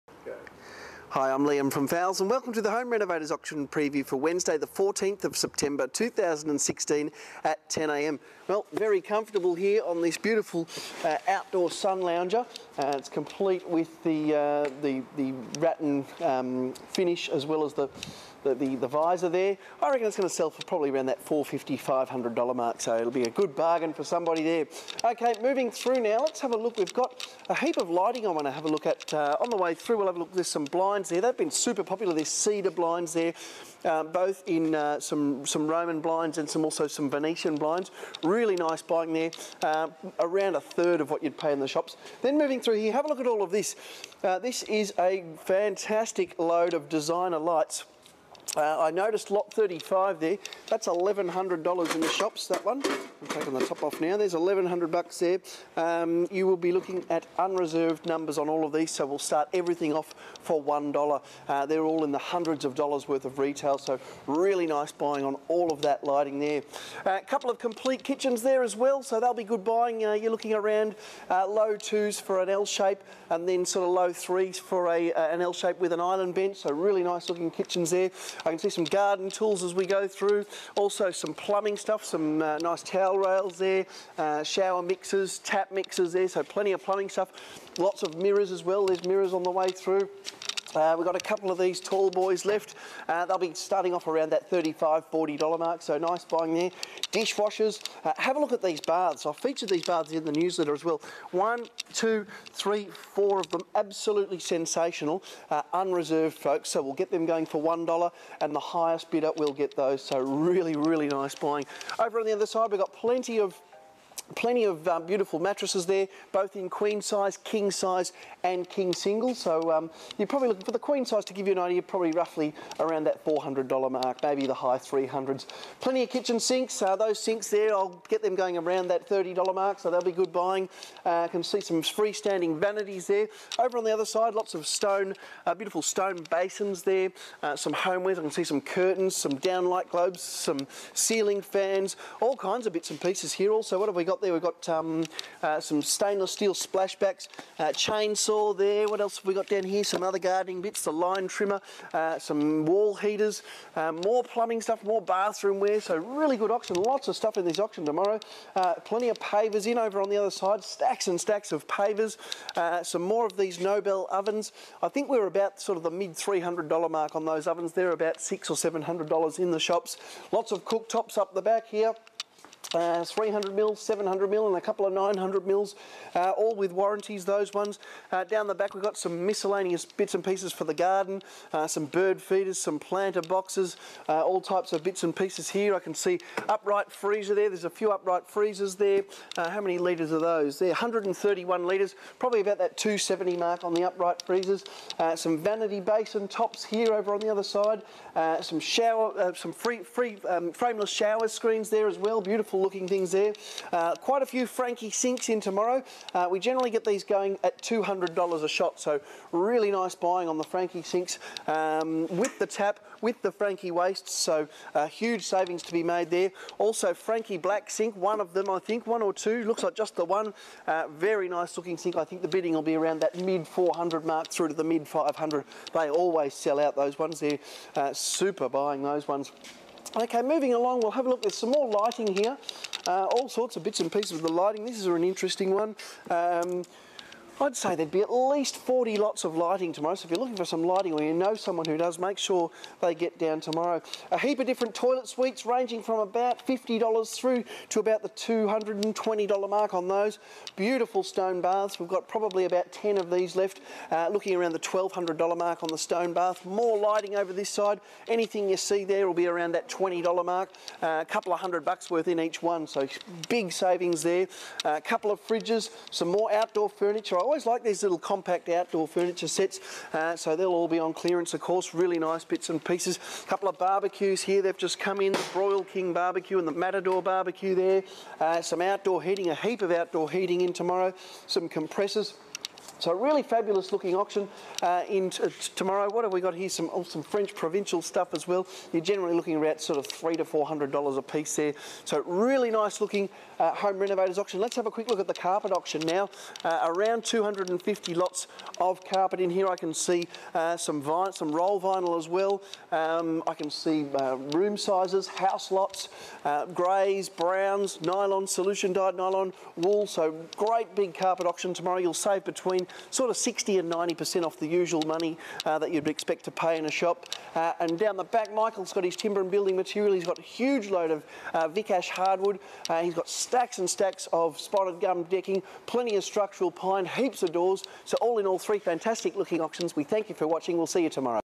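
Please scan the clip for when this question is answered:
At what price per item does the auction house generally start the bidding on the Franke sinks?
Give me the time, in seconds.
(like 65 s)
207 s.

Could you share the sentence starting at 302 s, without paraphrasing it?
Um, I can see uh, room sizes, house lots, greys, browns, nylon, solution dyed nylon, wool.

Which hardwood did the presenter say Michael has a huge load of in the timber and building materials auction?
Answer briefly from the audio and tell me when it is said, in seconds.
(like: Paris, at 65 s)
Vic Ash, at 321 s.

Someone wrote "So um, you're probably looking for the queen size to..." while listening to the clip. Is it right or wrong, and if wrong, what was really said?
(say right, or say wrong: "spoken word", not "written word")
right.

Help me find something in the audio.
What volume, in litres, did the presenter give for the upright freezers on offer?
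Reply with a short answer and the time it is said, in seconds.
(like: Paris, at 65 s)
131 litres, at 190 s.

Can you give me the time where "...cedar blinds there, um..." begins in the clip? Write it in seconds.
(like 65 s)
32 s.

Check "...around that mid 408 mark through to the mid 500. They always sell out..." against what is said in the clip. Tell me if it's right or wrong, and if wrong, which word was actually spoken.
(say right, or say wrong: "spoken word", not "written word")
wrong: "400", not "408".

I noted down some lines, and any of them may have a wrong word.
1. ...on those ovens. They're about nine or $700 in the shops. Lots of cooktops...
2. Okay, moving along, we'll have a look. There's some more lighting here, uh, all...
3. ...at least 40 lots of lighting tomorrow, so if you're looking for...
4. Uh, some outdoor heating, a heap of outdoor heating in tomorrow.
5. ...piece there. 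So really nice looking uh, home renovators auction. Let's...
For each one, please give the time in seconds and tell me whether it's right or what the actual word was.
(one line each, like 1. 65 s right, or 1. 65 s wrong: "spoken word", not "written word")
1. 167 s wrong: "six", not "nine"
2. 229 s right
3. 238 s right
4. 278 s right
5. 291 s right.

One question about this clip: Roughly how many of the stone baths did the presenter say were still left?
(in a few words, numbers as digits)
10.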